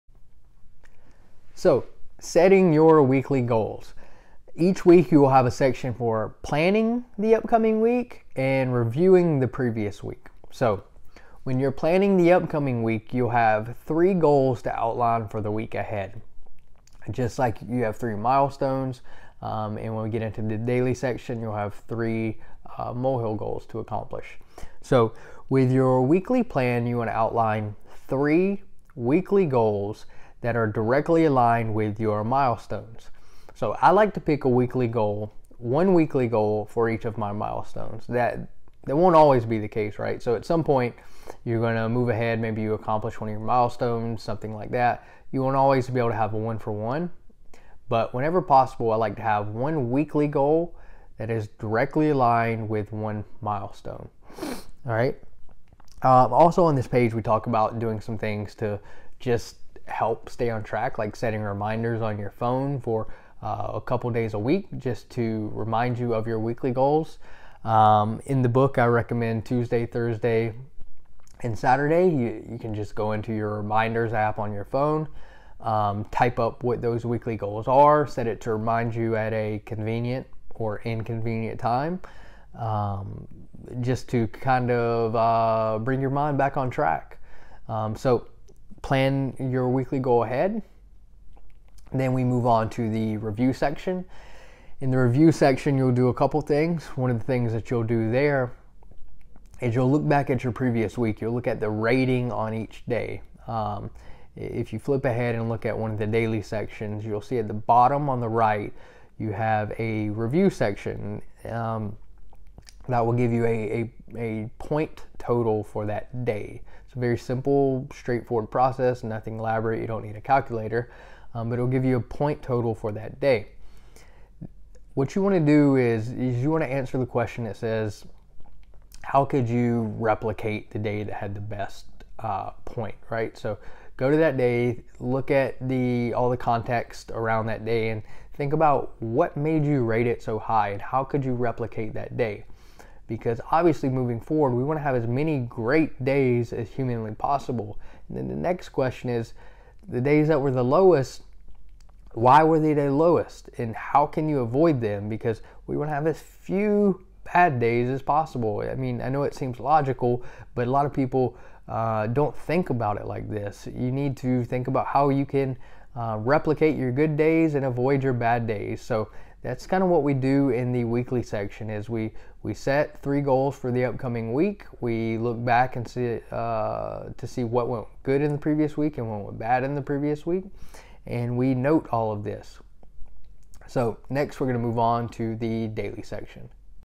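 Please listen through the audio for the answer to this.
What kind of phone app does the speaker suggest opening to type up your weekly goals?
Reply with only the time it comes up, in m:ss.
1:13.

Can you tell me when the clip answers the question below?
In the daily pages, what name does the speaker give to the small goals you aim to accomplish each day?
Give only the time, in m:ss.
0:22.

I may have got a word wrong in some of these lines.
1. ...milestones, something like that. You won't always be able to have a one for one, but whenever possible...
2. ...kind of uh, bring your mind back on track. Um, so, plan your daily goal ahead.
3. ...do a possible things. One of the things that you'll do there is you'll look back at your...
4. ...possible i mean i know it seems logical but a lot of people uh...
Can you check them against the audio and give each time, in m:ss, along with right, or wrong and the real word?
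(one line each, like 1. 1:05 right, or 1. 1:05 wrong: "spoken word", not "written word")
1. 0:43 right
2. 1:24 wrong: "weekly", not "daily"
3. 1:35 wrong: "couple", not "possible"
4. 2:38 right.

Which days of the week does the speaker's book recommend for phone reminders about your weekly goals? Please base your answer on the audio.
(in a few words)
Tuesday, Thursday, and Saturday.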